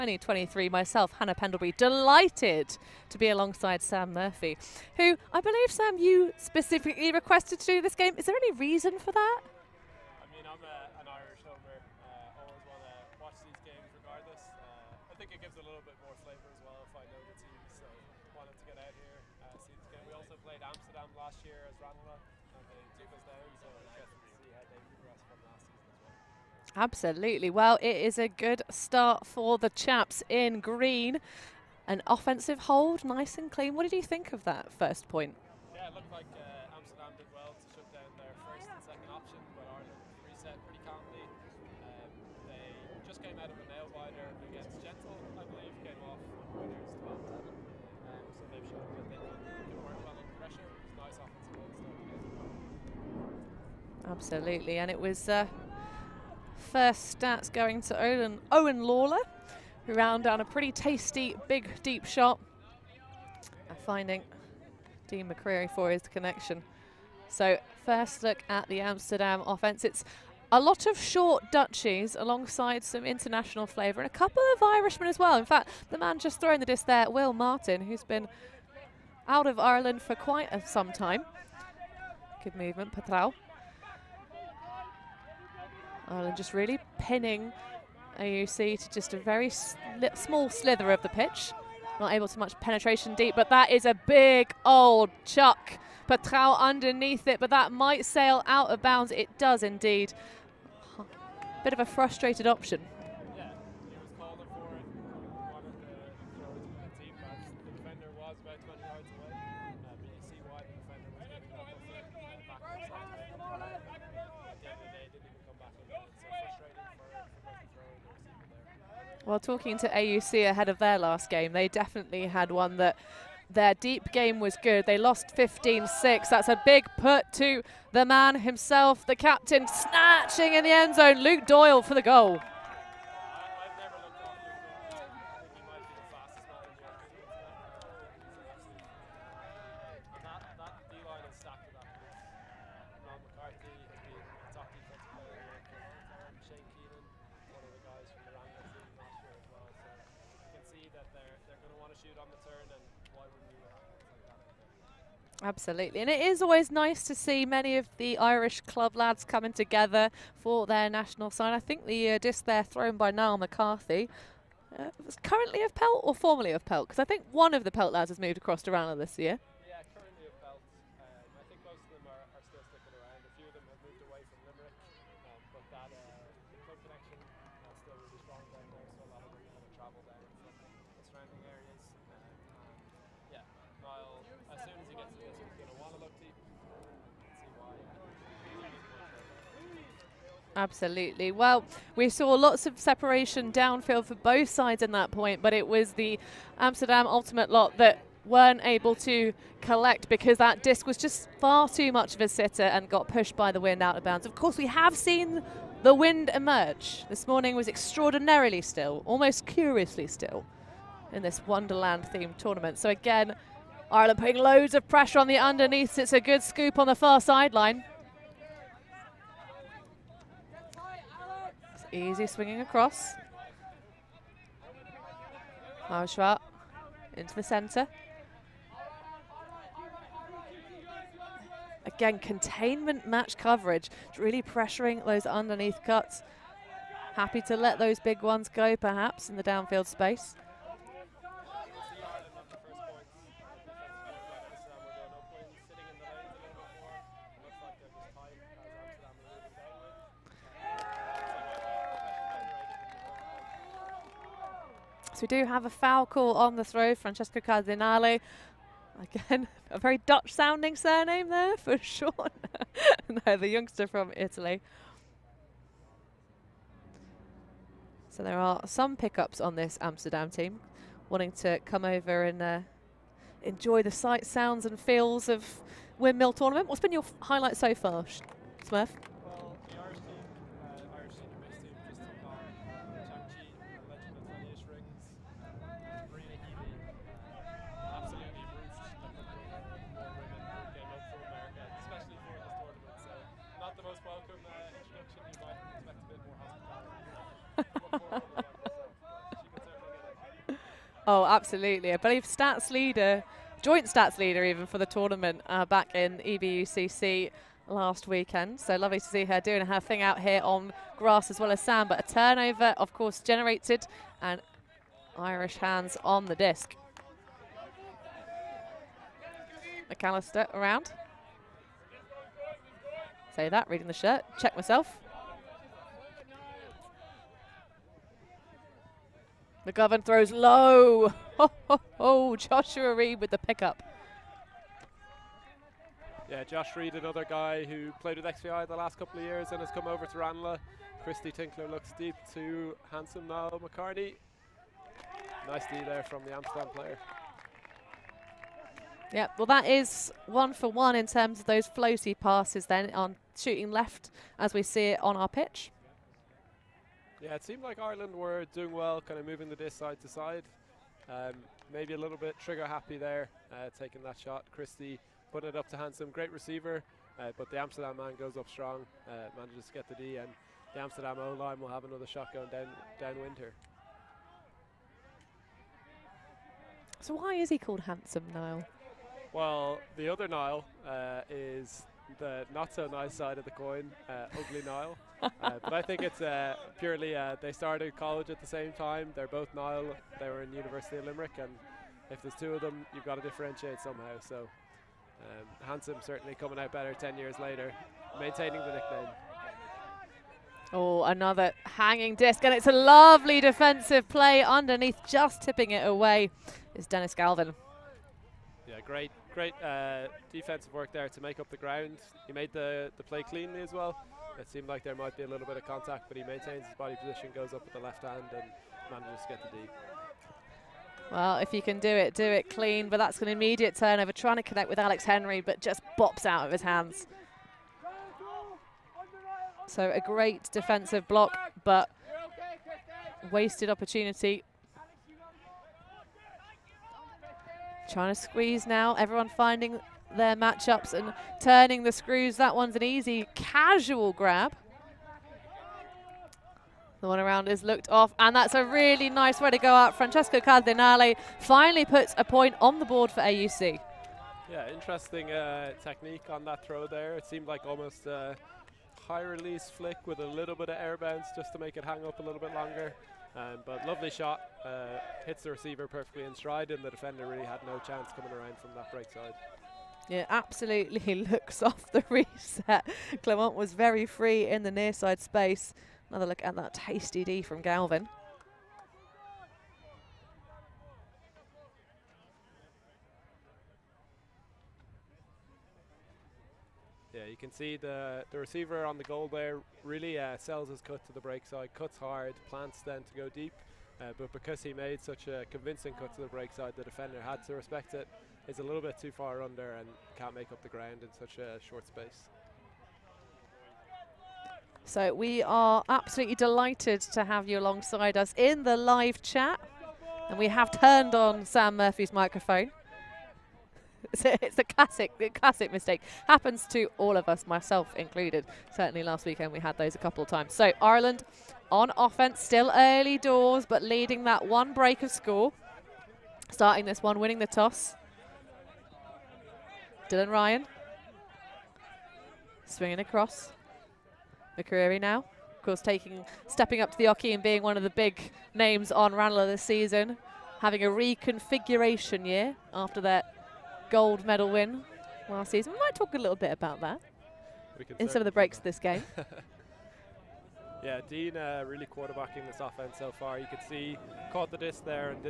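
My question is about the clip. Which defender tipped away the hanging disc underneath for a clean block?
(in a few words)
Dennis Galvin.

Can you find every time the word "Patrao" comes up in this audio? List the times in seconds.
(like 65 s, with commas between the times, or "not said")
82 s, 96 s.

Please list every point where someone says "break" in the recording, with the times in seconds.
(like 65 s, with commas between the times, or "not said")
491 s, 496 s, 524 s, 548 s.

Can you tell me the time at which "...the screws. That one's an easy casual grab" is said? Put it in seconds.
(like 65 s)
441 s.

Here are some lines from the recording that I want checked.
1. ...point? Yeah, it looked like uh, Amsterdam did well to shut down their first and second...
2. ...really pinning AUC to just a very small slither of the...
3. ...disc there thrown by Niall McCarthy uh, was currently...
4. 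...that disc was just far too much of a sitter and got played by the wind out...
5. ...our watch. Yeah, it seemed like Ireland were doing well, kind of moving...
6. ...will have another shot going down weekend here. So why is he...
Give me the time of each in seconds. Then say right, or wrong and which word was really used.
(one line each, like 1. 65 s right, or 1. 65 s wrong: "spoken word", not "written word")
1. 35 s right
2. 86 s right
3. 162 s right
4. 200 s wrong: "pushed", not "played"
5. 355 s wrong: "pitch", not "watch"
6. 371 s wrong: "downwind", not "weekend".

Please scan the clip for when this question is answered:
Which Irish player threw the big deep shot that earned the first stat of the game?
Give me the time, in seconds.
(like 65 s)
58 s.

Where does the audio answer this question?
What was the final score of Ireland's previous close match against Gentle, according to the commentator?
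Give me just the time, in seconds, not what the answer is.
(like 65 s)
48 s.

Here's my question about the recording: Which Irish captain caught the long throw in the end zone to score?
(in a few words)
Luke Doyle.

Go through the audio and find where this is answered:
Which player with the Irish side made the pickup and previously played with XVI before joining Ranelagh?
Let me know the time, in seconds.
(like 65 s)
332 s.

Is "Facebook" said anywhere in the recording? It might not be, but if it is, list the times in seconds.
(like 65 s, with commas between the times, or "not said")
not said.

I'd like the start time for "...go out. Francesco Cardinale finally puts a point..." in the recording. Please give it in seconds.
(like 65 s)
449 s.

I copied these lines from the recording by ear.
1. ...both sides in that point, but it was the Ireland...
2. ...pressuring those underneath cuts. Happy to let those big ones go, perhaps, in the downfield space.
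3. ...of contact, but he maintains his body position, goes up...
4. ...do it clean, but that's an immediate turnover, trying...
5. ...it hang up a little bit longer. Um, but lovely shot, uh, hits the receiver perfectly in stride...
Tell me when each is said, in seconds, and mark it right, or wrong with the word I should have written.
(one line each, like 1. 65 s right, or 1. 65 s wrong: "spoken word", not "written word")
1. 194 s wrong: "Amsterdam", not "Ireland"
2. 234 s right
3. 415 s right
4. 422 s right
5. 461 s right.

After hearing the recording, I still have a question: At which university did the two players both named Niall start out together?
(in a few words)
University of Limerick.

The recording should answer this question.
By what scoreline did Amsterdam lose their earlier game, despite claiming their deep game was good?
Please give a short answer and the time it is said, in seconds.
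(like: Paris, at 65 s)
15-6, at 125 s.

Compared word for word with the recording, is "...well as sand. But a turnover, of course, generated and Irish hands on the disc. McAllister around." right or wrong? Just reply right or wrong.
right.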